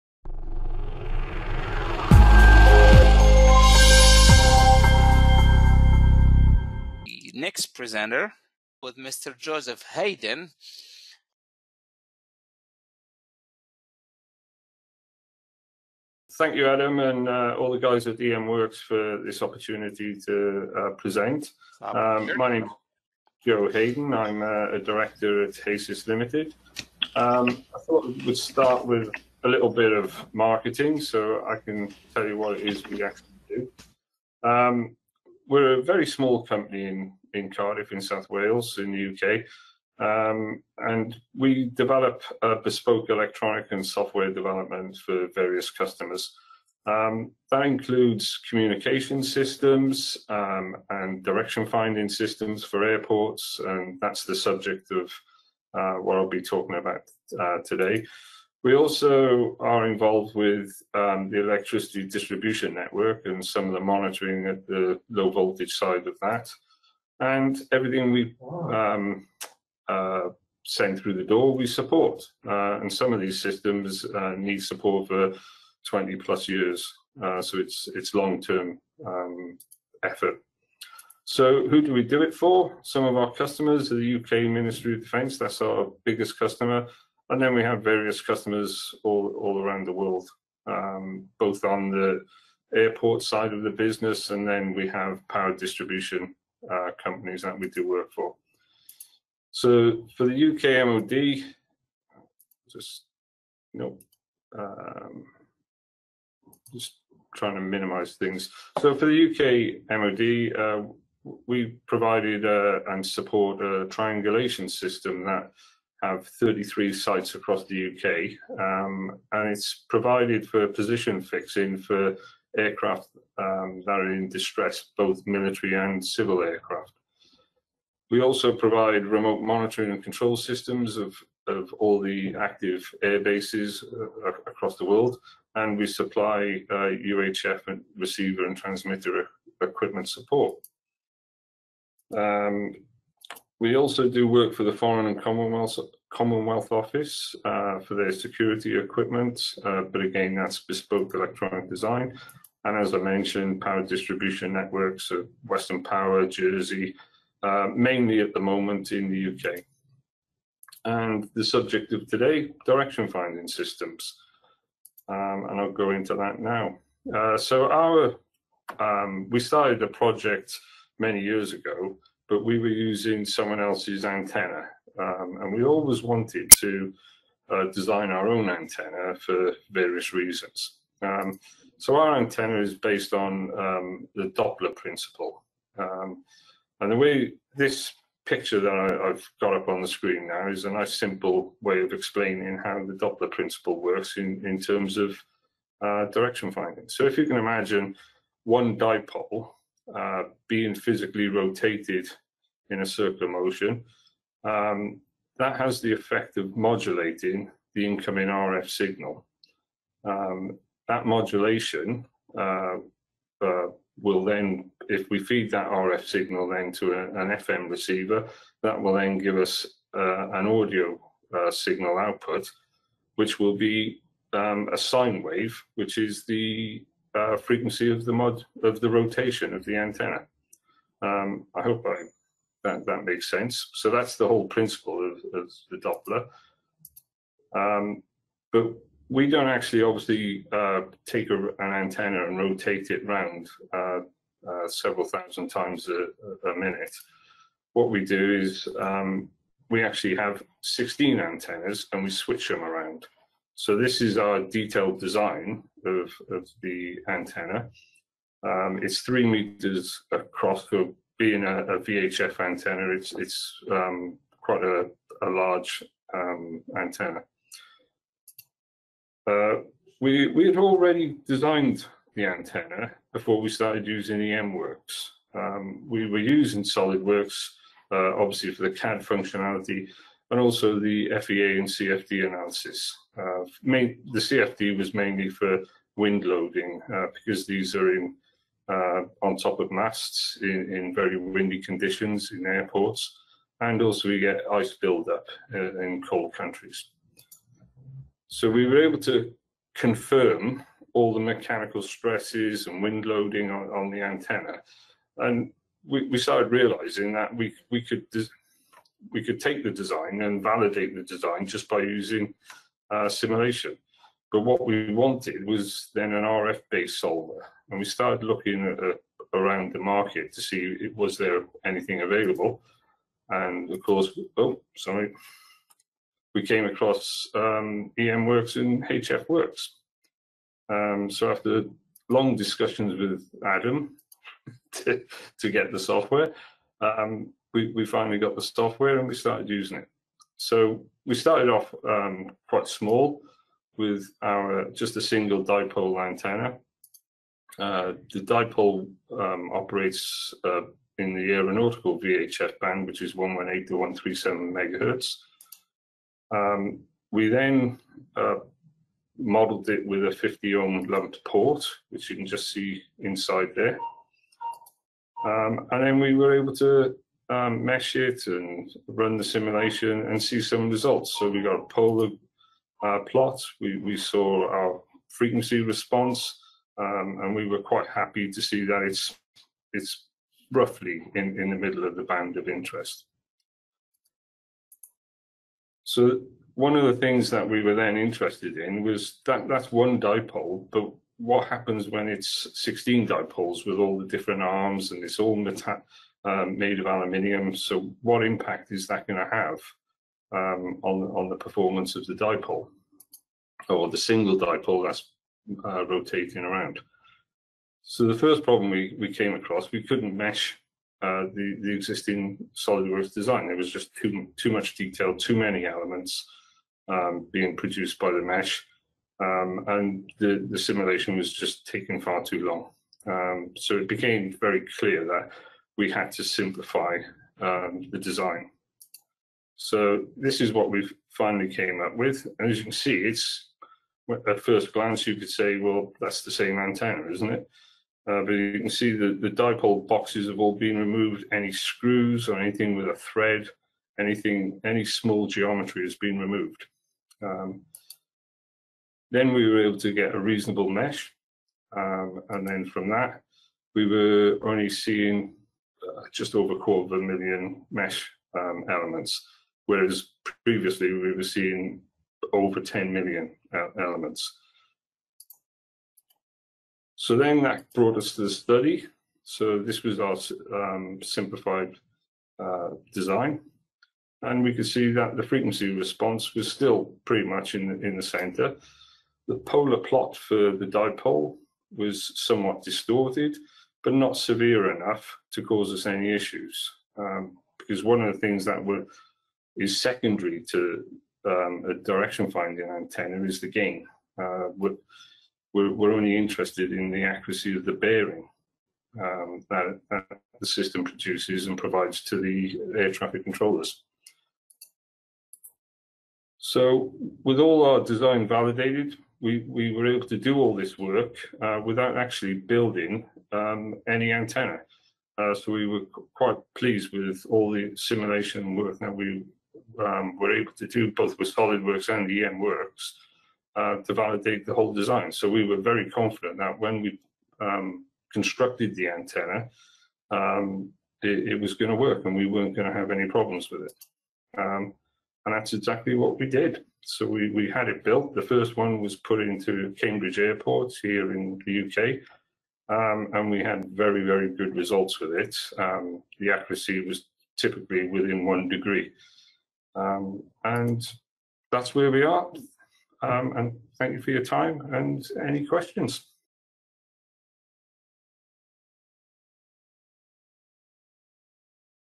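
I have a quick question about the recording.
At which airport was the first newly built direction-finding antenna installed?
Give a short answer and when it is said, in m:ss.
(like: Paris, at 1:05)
Cambridge Airport, at 8:59.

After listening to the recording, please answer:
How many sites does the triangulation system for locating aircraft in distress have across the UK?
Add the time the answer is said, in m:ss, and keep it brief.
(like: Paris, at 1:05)
33, at 1:56.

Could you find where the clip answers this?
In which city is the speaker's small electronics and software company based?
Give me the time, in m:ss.
0:37.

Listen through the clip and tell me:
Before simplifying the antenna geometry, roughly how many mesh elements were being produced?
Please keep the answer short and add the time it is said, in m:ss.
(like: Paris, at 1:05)
over 10 million, at 7:42.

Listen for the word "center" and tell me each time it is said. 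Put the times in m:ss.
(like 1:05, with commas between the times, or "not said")
7:58.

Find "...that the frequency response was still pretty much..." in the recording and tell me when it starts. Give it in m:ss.
7:54.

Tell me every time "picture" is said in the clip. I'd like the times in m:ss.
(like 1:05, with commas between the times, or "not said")
3:08.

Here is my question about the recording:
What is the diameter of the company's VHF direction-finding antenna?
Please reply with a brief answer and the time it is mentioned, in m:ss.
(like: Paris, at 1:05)
3 meters, at 4:18.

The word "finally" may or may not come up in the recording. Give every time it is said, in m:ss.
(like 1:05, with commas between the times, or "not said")
5:37, 7:11.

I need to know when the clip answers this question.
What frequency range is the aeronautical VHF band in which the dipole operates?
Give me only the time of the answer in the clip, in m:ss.
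5:53.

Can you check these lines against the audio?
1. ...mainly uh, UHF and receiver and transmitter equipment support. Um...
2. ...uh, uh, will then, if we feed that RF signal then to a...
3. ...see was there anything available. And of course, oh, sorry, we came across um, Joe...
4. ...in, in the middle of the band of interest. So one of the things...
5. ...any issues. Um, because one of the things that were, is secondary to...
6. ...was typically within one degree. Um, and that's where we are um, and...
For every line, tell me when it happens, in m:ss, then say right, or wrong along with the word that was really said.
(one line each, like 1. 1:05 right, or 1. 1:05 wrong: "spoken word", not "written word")
1. 2:15 wrong: "supply", not "mainly"
2. 3:32 right
3. 5:20 wrong: "Works", not "Joe"
4. 6:21 right
5. 8:05 right
6. 9:06 right.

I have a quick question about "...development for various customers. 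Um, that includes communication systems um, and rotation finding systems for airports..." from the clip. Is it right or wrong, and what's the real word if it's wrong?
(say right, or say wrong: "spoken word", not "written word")
wrong: "direction", not "rotation".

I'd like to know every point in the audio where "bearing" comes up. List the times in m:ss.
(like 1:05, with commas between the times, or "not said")
8:17.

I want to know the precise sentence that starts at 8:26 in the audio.
So with all our design validated, we, we were able to do all this work uh, without actually building um, any antenna.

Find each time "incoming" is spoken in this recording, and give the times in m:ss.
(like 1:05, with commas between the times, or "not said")
3:27.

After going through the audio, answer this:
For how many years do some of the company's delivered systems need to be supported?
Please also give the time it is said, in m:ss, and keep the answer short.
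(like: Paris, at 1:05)
20 plus years, at 1:15.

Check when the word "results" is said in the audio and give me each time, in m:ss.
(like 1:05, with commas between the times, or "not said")
6:10, 9:04.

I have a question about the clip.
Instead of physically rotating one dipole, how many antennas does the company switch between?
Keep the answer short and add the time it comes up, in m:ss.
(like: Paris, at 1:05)
16, at 4:10.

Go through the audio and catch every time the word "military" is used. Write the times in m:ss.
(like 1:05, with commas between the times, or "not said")
2:05.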